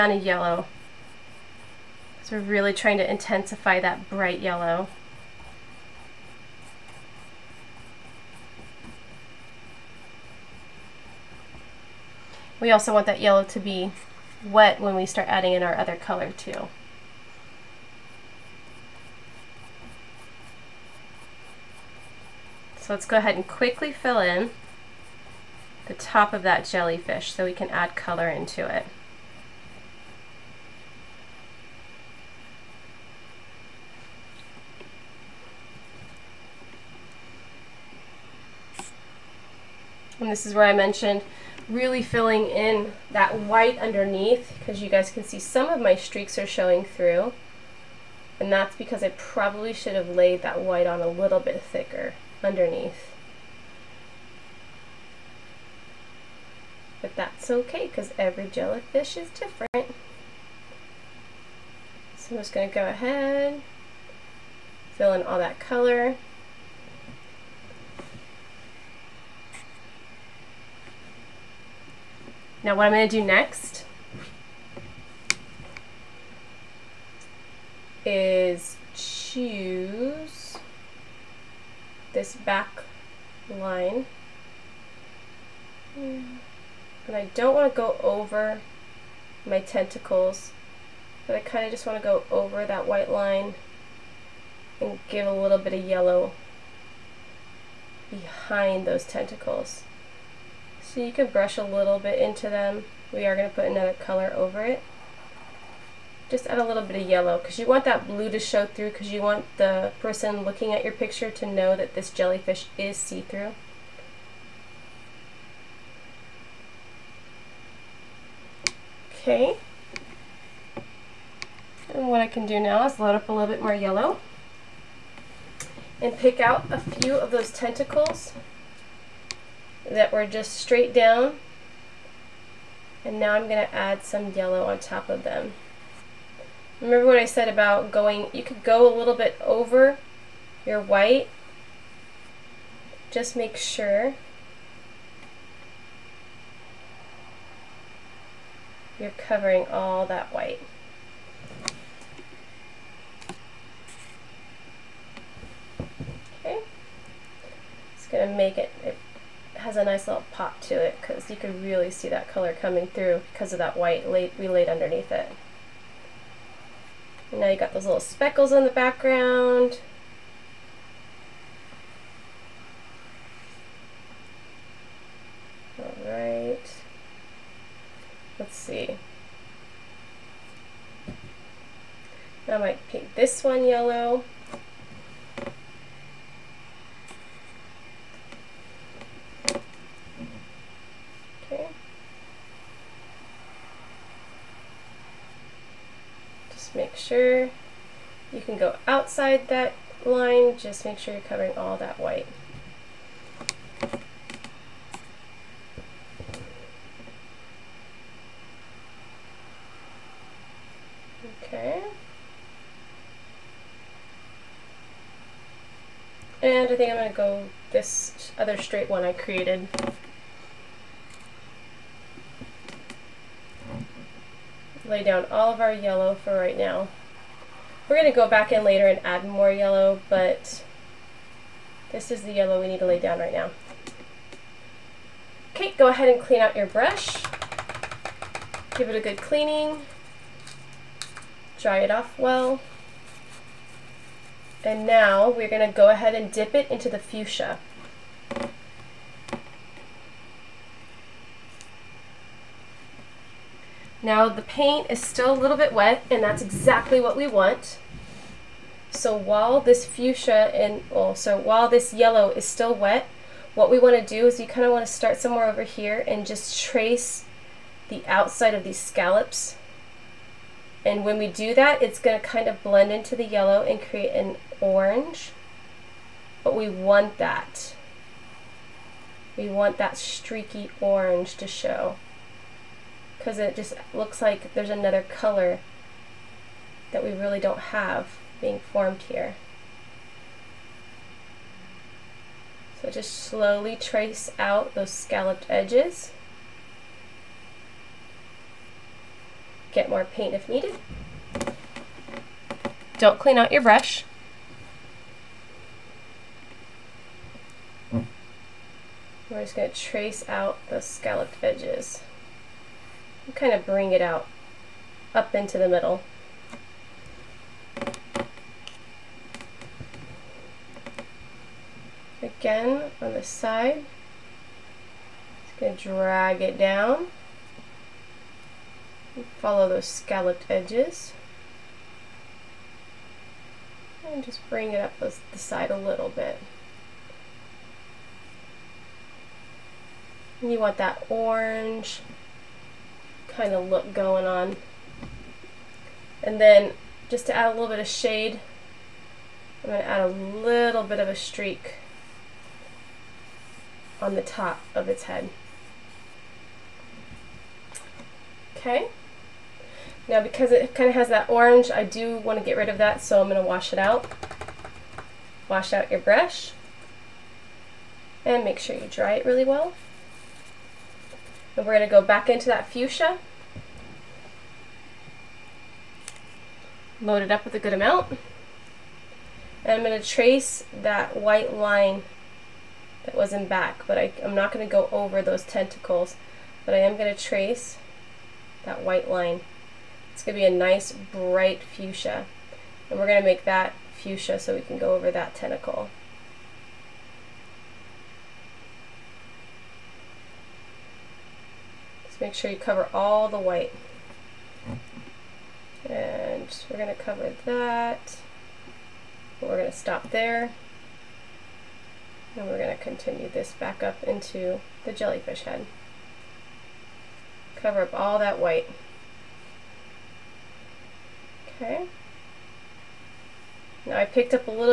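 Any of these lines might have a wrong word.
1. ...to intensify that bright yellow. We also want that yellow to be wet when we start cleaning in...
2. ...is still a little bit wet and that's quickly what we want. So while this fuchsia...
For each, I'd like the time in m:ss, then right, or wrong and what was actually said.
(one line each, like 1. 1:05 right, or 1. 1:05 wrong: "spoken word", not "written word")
1. 0:02 wrong: "adding", not "cleaning"
2. 4:14 wrong: "exactly", not "quickly".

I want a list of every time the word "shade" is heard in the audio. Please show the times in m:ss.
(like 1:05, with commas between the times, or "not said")
5:47.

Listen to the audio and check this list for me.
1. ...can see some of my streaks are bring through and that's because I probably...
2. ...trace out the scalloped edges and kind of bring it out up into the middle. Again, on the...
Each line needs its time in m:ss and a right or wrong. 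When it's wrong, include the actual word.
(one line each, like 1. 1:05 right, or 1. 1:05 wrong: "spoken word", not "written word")
1. 0:45 wrong: "showing", not "bring"
2. 5:09 right.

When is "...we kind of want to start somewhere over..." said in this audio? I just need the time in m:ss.
4:24.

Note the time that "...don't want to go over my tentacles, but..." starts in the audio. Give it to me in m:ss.
1:27.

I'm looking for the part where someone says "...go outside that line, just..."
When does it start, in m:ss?
3:18.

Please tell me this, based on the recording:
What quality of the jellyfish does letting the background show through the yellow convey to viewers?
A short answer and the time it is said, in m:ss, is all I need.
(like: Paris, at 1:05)
See-through, at 1:52.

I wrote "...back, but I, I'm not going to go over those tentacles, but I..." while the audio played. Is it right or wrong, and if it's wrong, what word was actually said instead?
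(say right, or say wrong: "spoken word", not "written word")
right.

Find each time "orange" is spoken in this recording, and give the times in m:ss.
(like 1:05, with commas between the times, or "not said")
4:34, 4:40, 5:41, 6:01.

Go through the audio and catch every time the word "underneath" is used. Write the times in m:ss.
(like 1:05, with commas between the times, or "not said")
0:43, 0:52, 2:44.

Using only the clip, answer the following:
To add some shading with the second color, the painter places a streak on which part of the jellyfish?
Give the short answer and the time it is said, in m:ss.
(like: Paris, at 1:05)
Top of its head, at 5:54.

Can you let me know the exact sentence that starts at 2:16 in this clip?
Remember what I said about going, you could go a little bit over your white.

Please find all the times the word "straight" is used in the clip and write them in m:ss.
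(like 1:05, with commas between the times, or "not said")
2:10, 3:38.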